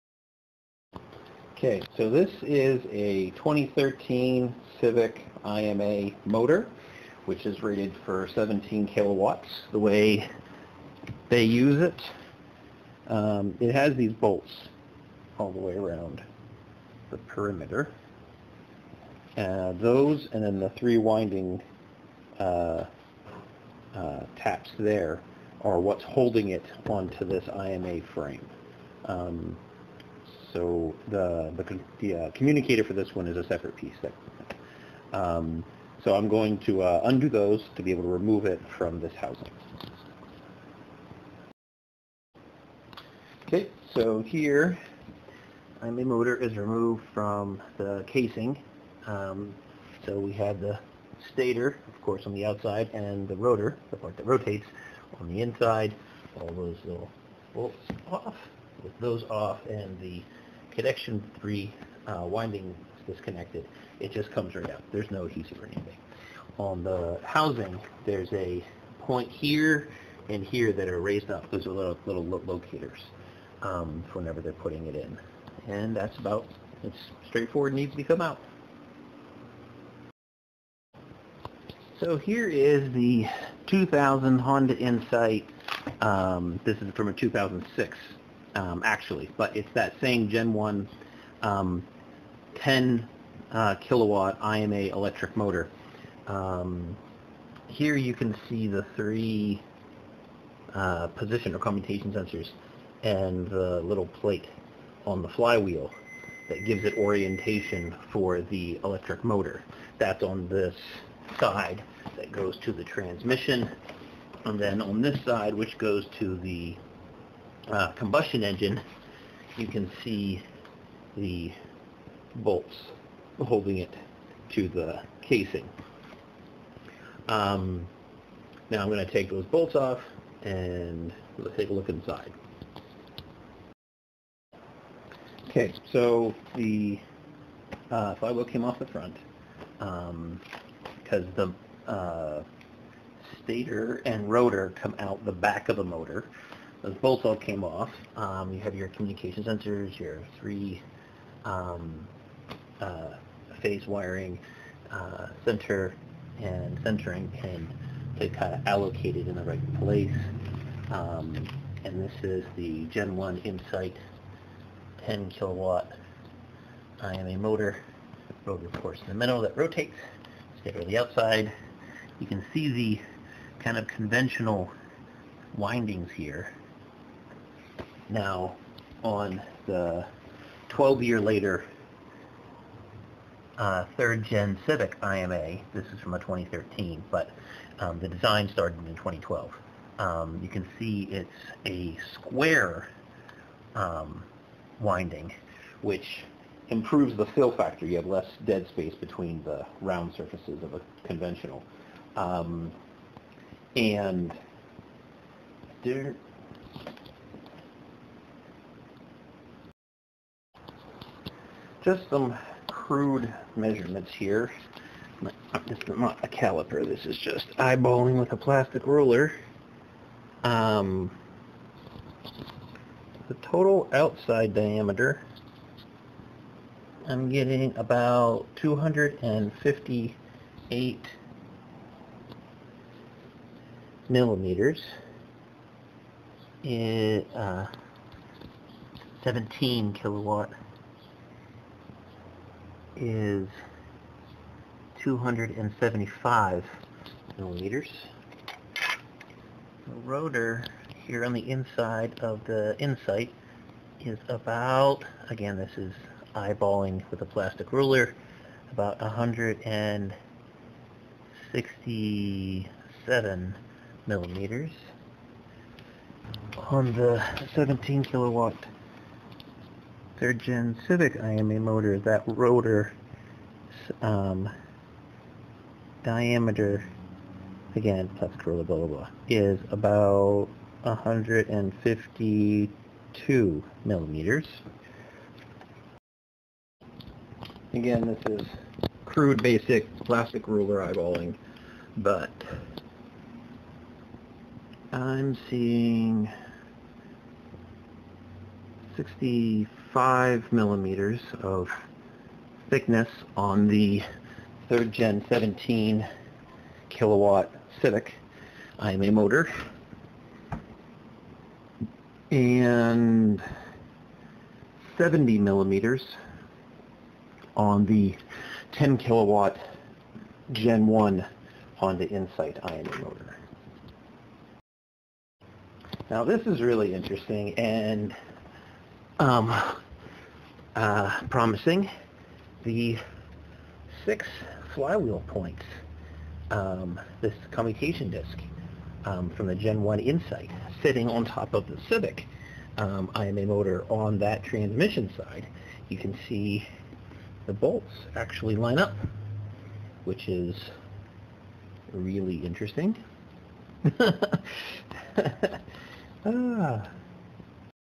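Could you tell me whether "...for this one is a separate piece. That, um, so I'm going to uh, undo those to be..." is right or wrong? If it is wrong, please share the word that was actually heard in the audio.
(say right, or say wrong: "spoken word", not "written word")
right.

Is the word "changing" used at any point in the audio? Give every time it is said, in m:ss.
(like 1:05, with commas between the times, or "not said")
not said.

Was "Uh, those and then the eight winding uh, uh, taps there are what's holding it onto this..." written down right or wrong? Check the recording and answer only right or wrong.
wrong.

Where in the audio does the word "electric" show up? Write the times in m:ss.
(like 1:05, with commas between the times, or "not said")
1:34, 1:48.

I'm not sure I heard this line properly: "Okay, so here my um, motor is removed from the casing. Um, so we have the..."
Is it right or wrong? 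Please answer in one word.
right.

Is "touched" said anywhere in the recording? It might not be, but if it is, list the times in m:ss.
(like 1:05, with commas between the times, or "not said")
not said.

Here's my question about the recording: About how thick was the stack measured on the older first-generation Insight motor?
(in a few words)
70 millimeters.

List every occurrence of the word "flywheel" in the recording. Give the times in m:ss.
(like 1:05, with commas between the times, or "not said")
1:45, 2:18, 5:34.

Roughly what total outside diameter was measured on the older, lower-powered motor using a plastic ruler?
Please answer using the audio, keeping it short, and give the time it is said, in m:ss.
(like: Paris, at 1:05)
258 millimeters, at 3:48.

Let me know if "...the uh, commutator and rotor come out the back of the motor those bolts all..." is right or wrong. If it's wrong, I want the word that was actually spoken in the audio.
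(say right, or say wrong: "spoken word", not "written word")
wrong: "stator", not "commutator".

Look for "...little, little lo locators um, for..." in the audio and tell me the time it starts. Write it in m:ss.
1:11.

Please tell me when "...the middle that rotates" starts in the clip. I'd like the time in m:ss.
2:49.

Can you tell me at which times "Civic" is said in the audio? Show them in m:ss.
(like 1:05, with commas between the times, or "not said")
0:04, 3:04, 4:30, 5:07, 5:41.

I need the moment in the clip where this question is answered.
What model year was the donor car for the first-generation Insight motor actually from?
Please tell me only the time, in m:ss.
1:27.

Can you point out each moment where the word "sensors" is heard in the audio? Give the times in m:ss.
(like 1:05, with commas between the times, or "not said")
1:42, 2:29.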